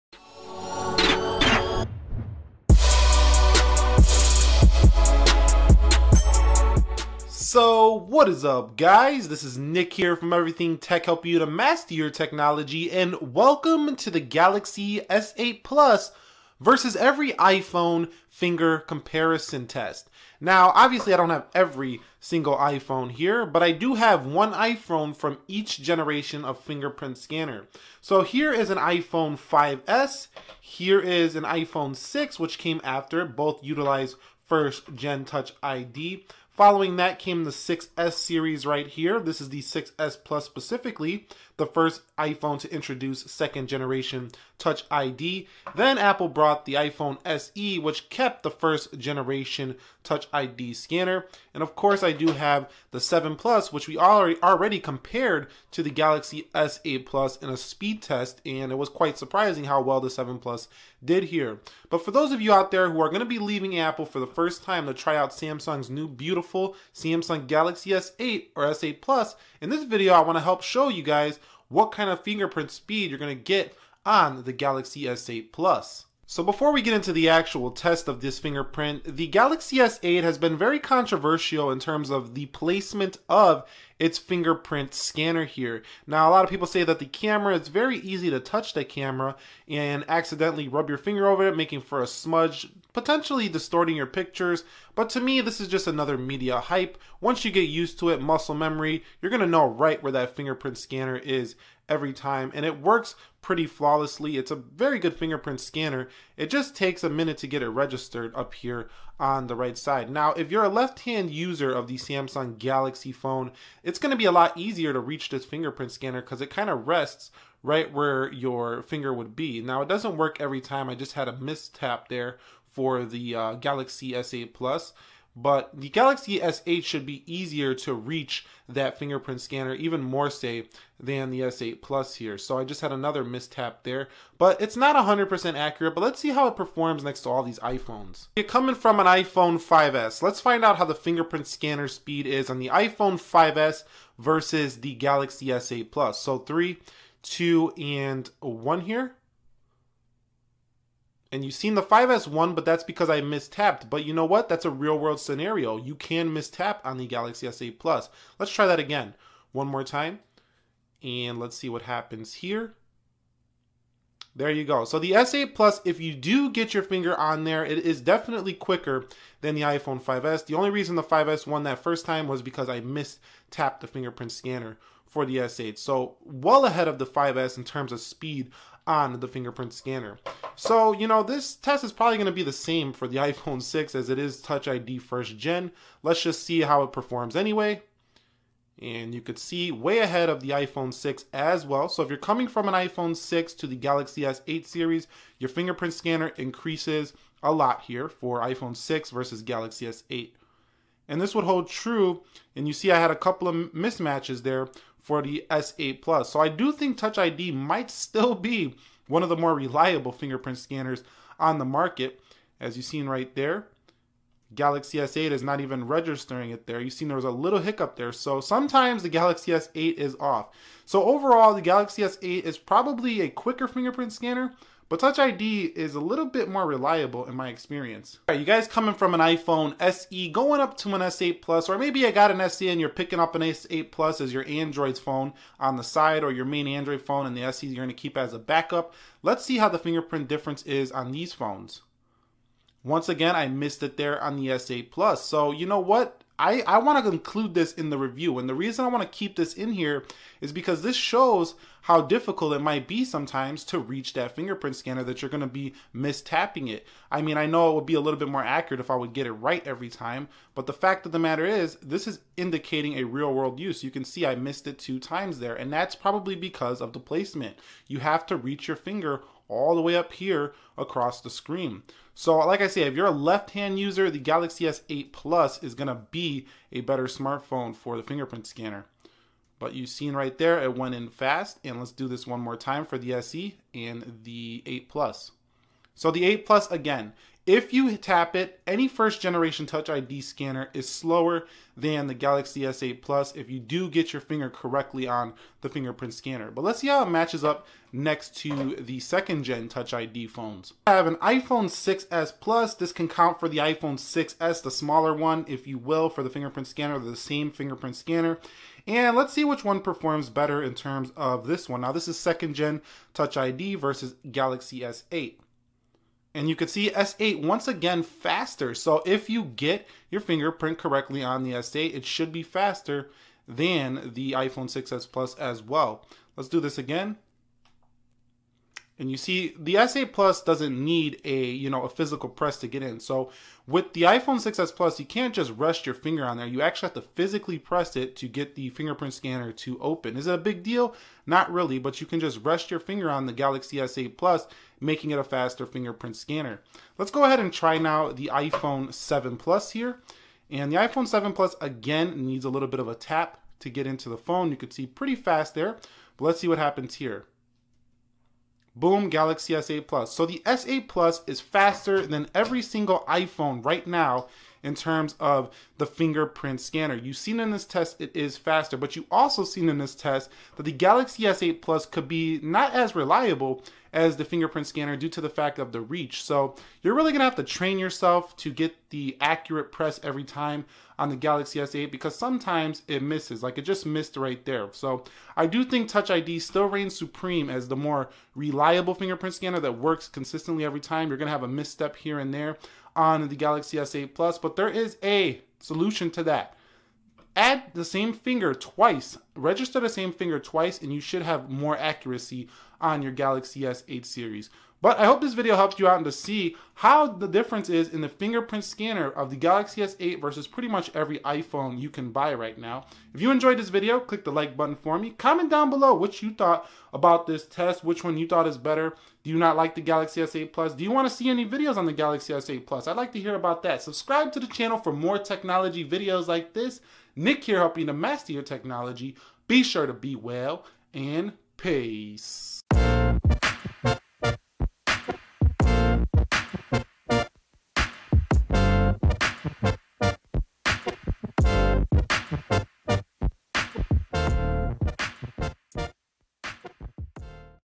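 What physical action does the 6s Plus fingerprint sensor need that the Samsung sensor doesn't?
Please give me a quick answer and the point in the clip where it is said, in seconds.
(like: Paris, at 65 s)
A physical press, at 331 s.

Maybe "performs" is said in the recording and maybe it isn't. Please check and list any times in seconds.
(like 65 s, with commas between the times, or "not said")
136 s, 186 s, 309 s.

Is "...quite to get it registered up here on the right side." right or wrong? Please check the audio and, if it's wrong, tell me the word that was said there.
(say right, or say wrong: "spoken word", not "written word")
wrong: "minute", not "quite".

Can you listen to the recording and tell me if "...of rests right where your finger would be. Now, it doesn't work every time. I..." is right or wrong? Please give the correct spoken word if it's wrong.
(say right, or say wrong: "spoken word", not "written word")
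right.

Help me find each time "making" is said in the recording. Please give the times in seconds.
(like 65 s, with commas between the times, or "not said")
91 s, 344 s.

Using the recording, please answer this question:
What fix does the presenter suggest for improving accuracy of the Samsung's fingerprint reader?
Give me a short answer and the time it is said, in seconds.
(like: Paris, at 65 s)
Register the same finger twice, at 399 s.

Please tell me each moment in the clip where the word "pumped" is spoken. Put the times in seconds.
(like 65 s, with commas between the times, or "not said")
not said.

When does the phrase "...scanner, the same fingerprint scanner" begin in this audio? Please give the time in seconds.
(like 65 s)
306 s.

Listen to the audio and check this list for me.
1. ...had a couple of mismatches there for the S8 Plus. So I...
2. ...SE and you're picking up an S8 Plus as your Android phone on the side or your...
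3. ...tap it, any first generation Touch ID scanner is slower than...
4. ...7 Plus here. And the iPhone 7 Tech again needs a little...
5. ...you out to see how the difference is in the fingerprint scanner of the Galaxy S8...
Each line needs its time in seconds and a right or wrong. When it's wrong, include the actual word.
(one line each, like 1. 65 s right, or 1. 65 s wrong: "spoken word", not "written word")
1. 202 s right
2. 232 s right
3. 287 s right
4. 348 s wrong: "Plus", not "Tech"
5. 405 s right.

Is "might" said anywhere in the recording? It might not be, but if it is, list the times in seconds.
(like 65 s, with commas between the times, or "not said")
207 s, 252 s.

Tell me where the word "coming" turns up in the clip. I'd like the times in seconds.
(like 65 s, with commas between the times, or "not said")
138 s, 192 s, 228 s.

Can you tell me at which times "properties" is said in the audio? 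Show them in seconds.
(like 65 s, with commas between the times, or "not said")
not said.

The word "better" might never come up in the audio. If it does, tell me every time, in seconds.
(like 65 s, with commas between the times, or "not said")
276 s, 310 s, 418 s.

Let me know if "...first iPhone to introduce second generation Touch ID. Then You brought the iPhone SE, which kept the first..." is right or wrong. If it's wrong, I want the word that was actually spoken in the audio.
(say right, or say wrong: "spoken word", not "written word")
wrong: "Apple", not "You".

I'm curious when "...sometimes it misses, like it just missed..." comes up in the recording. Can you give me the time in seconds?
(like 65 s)
382 s.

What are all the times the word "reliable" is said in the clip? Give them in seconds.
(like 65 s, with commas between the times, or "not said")
209 s, 226 s, 372 s, 388 s.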